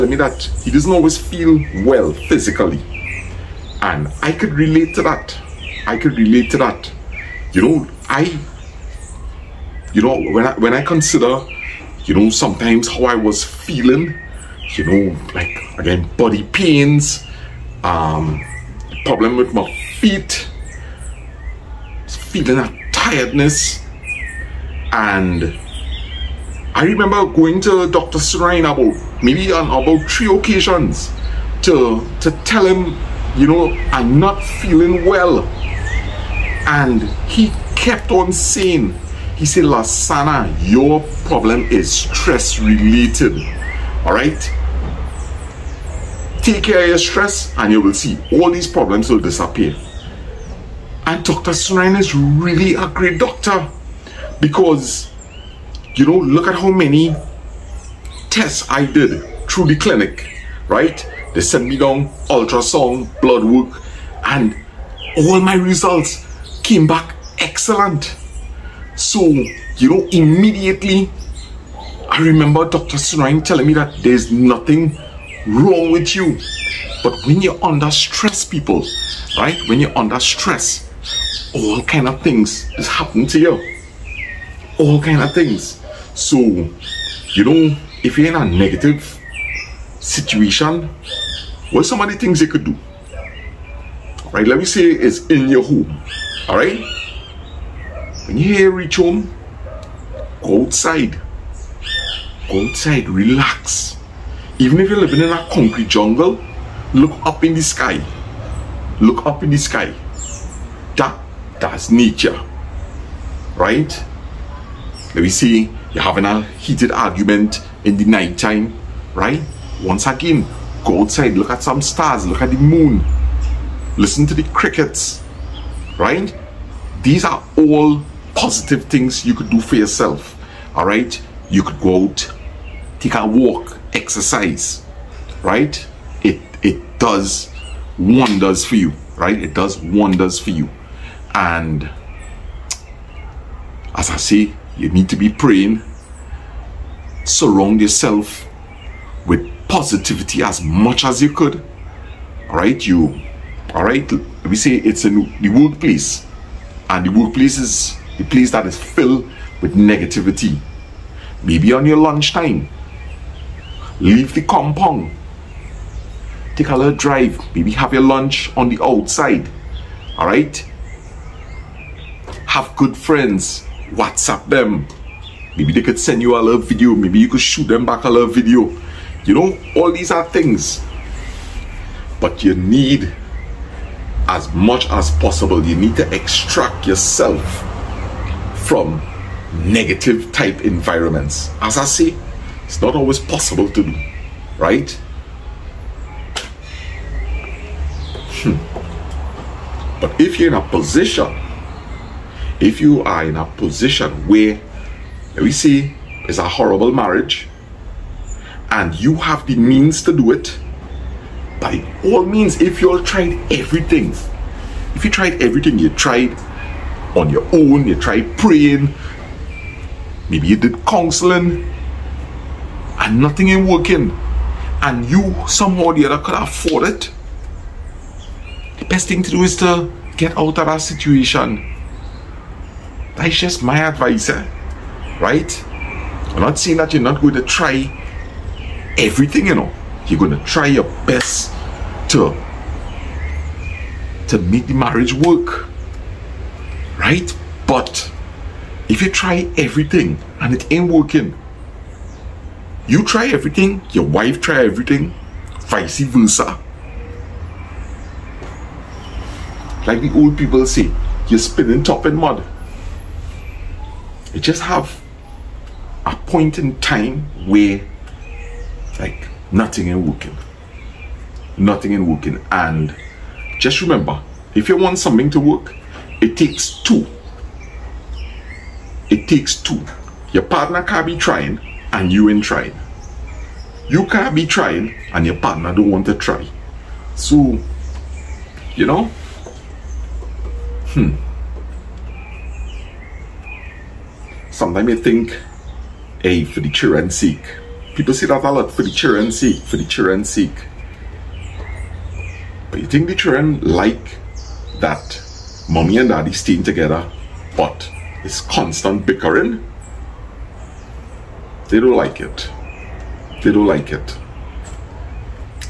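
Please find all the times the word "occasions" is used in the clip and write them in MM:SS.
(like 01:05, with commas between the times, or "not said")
00:30.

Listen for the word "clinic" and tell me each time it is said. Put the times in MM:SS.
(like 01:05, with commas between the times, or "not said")
00:59.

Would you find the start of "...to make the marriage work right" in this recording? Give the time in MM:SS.
04:04.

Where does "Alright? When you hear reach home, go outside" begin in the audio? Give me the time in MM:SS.
01:36.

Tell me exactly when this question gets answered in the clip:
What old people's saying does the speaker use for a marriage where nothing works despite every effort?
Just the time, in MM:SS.
04:21.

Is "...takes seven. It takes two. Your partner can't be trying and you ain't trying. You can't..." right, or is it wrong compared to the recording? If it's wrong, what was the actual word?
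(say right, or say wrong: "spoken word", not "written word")
wrong: "two", not "seven".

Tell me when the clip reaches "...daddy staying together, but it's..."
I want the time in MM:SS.
05:06.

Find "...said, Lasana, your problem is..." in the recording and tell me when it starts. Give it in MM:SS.
00:39.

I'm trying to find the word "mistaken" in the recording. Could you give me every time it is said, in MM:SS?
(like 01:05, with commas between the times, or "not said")
not said.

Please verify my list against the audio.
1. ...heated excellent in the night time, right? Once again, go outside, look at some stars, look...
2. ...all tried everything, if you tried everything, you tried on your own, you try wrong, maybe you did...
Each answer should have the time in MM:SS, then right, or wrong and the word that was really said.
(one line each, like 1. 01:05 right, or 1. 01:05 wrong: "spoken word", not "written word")
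1. 01:56 wrong: "argument", not "excellent"
2. 03:32 wrong: "praying", not "wrong".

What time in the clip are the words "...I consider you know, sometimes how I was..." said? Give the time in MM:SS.
00:10.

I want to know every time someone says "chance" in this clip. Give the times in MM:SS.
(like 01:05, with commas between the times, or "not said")
not said.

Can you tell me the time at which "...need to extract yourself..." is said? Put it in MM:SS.
03:05.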